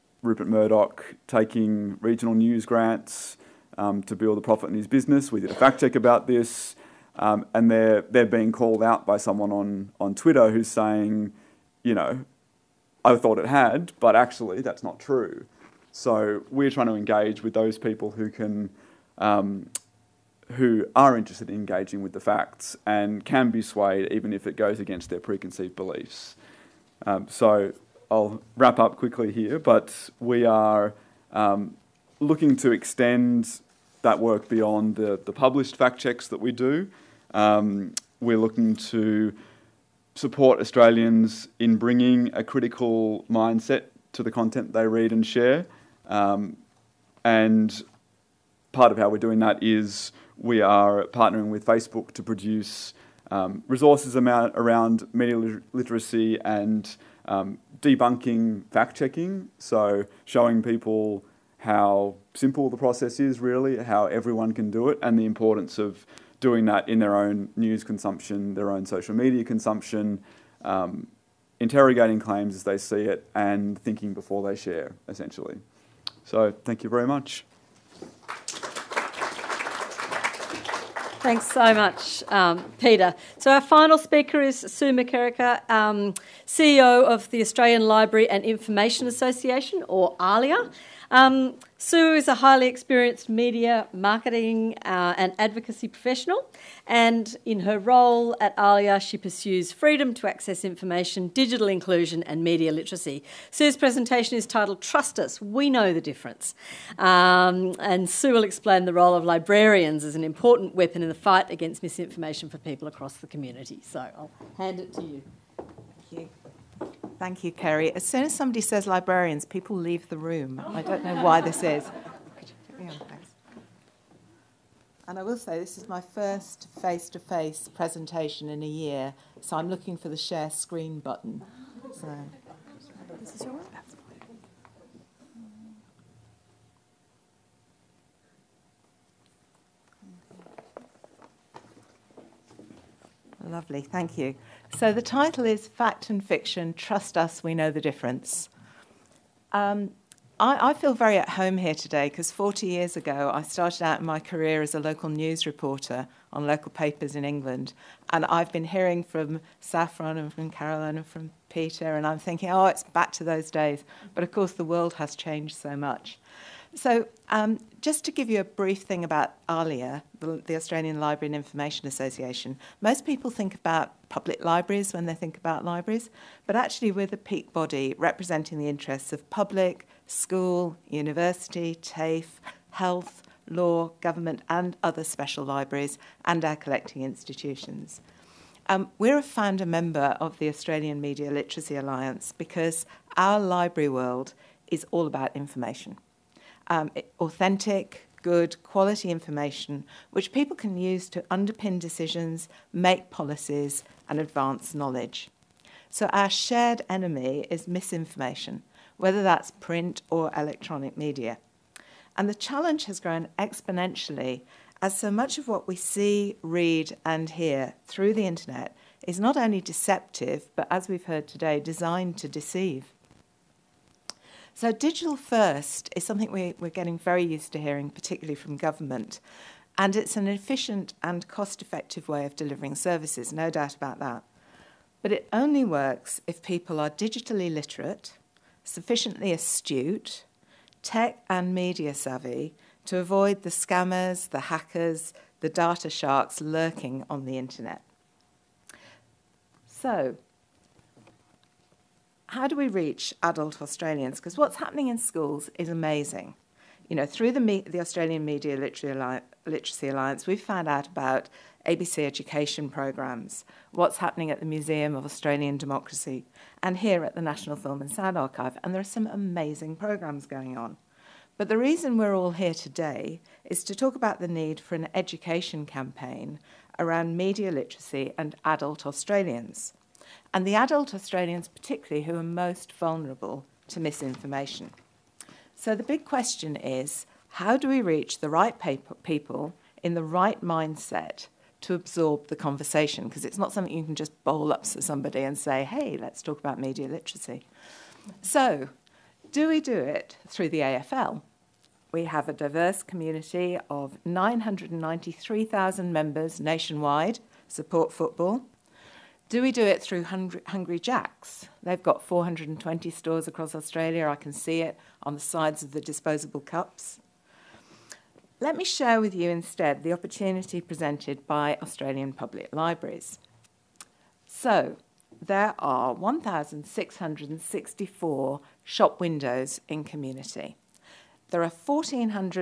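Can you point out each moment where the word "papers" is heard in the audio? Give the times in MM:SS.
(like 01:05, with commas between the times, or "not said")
02:36.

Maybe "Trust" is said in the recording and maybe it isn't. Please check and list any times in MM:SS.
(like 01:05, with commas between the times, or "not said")
01:44, 02:26.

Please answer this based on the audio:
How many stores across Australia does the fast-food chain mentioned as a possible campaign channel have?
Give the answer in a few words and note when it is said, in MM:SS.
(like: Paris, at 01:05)
420, at 05:12.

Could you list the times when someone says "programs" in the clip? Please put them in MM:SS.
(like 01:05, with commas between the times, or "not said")
04:22, 04:29.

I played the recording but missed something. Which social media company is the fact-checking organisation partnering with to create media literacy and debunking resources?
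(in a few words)
Facebook.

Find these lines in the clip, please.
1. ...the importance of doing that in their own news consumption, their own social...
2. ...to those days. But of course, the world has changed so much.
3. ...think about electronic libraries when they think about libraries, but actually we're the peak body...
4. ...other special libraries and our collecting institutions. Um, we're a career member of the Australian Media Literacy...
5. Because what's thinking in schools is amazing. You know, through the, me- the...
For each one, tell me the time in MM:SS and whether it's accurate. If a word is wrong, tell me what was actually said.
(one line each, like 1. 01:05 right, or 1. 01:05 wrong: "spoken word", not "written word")
1. 01:05 right
2. 02:43 right
3. 02:53 wrong: "public", not "electronic"
4. 03:04 wrong: "founder", not "career"
5. 04:14 wrong: "happening", not "thinking".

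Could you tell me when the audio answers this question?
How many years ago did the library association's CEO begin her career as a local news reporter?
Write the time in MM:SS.
02:32.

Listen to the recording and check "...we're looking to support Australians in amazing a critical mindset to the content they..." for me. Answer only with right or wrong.
wrong.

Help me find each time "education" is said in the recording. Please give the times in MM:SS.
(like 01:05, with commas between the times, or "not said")
04:22, 04:34.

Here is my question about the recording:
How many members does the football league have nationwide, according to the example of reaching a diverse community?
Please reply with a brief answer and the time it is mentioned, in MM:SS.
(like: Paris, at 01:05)
993,000, at 05:04.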